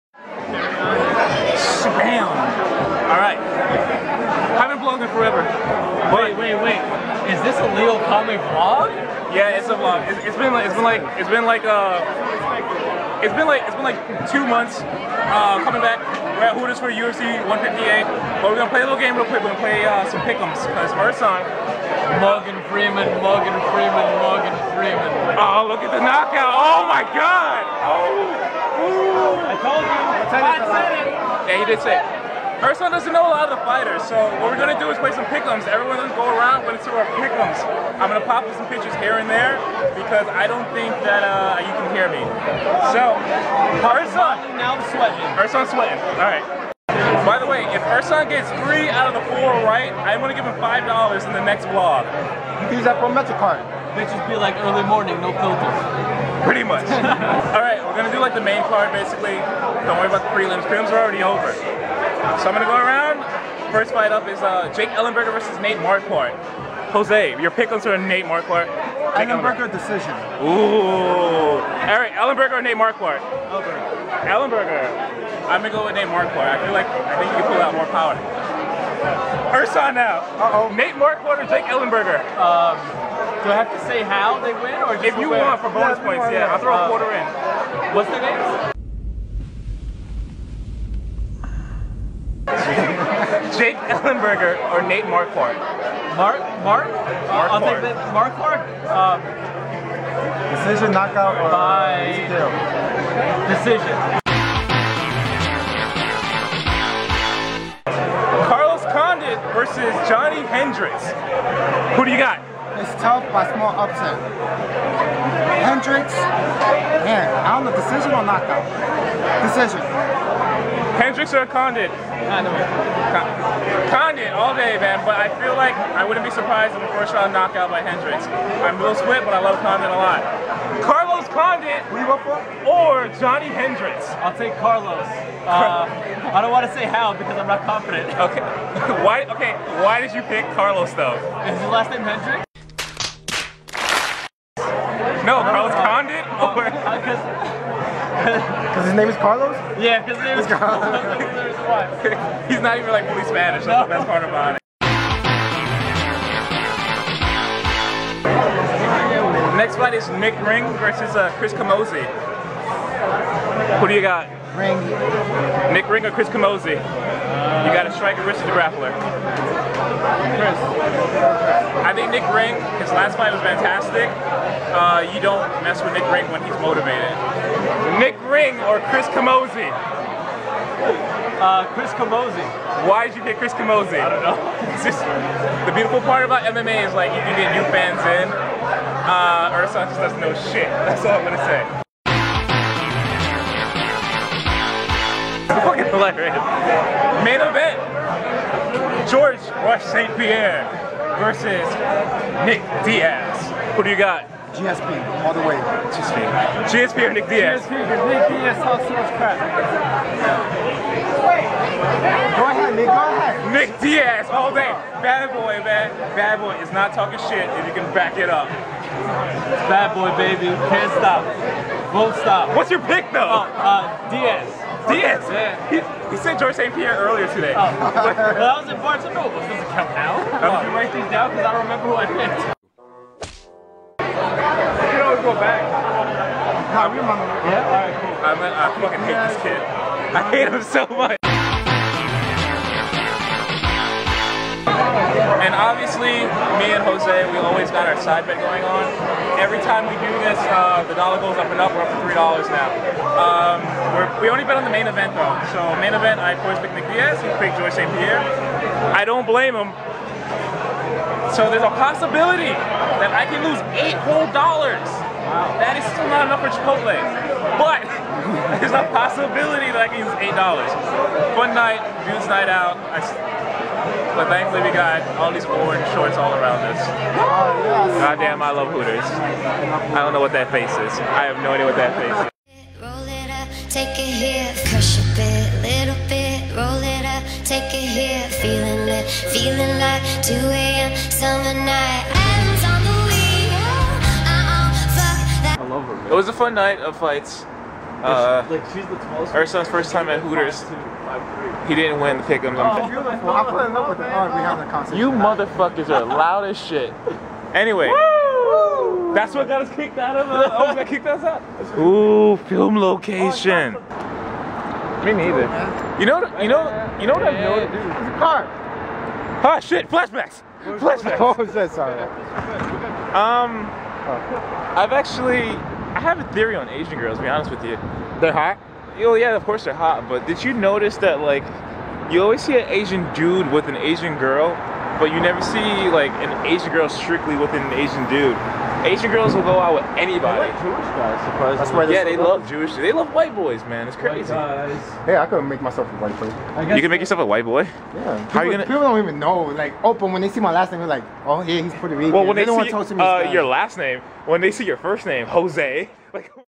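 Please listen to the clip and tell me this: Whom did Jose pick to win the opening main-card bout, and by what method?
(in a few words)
Jake Ellenberger, decision.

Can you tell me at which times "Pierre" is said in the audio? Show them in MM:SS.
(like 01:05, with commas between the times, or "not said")
03:20, 03:46, 04:17.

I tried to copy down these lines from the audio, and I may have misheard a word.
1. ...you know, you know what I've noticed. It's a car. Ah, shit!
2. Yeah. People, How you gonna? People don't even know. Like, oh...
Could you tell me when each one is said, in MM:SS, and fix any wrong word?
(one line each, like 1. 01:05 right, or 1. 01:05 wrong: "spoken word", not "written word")
1. 05:16 right
2. 05:47 right.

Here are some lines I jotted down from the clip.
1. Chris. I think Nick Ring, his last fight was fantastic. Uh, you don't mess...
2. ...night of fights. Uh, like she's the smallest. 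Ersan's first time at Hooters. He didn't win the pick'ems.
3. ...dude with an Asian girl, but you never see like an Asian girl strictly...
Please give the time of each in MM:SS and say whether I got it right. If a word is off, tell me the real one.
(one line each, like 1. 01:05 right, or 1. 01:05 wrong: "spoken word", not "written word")
1. 02:50 right
2. 04:56 right
3. 05:33 right.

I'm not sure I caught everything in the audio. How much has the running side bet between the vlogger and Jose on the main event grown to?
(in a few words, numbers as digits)
$3.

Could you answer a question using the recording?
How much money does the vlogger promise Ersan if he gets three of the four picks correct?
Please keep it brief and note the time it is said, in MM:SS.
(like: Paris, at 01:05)
$5, at 00:50.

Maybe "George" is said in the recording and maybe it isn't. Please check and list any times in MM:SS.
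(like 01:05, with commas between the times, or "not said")
03:19, 03:46.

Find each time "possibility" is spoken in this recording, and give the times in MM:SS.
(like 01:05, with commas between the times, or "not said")
04:21, 04:28.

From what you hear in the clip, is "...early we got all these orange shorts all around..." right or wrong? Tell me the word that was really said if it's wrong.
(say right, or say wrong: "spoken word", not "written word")
wrong: "thankfully", not "early".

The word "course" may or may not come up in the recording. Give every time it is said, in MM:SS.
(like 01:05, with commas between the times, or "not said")
04:16, 05:29.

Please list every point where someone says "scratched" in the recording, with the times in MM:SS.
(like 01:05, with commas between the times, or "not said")
not said.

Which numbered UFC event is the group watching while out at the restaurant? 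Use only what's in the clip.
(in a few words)
UFC 158.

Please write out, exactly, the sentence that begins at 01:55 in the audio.
Hendricks, man, I don't know, decision or knockout?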